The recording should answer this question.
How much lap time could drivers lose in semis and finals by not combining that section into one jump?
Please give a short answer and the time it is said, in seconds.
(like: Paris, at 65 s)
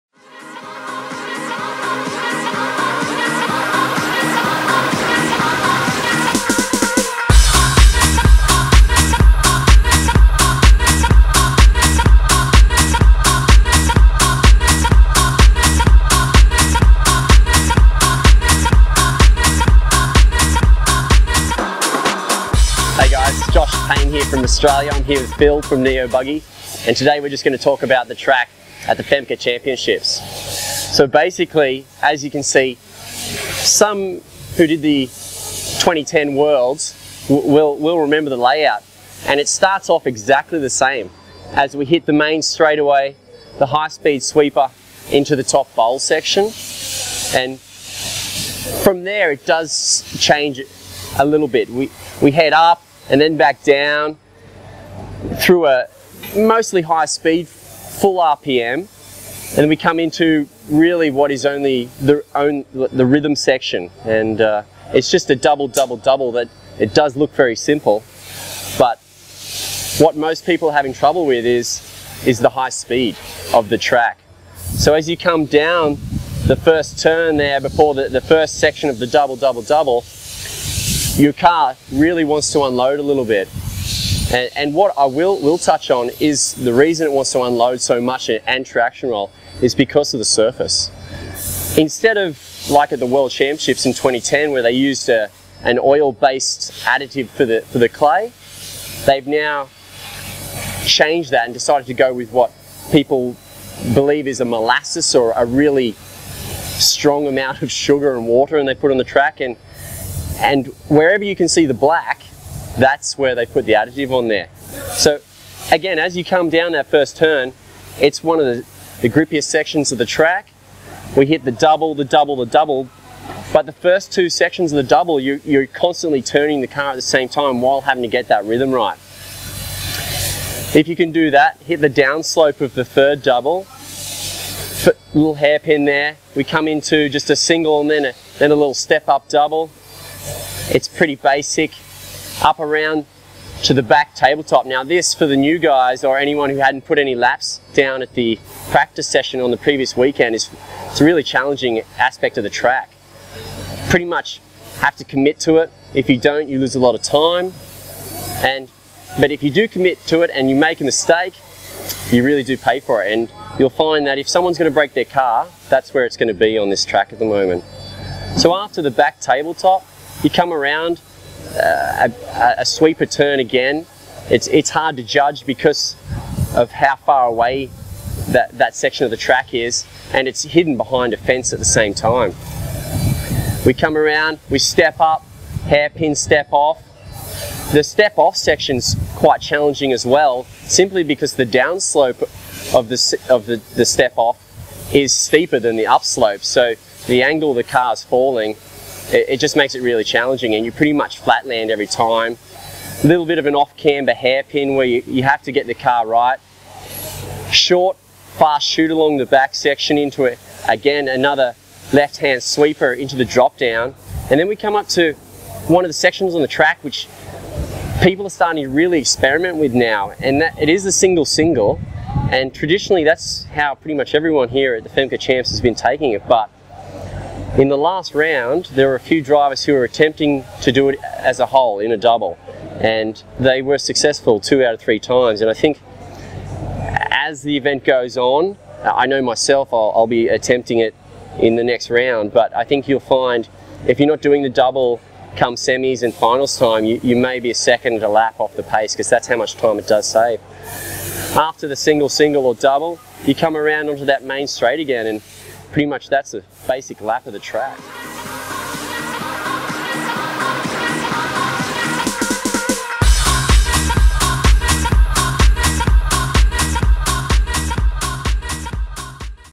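1 second a lap, at 247 s.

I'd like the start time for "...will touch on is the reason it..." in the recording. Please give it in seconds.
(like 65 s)
85 s.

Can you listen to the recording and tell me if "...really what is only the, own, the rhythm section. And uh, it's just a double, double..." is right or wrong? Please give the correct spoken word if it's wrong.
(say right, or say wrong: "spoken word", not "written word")
right.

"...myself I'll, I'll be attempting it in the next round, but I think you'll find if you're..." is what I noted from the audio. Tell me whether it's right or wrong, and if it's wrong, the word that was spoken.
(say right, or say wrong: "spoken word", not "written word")
right.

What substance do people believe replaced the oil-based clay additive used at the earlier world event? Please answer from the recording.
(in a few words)
molasses.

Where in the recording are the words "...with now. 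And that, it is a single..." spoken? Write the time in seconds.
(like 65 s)
219 s.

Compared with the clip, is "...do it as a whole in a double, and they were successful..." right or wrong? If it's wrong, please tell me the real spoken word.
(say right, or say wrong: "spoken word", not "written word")
right.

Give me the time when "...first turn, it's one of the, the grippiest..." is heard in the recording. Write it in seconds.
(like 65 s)
116 s.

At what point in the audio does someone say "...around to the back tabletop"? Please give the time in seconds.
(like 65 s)
142 s.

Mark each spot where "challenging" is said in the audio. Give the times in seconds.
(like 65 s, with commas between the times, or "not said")
151 s, 189 s, 200 s.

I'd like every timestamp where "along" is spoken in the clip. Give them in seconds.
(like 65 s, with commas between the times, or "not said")
208 s.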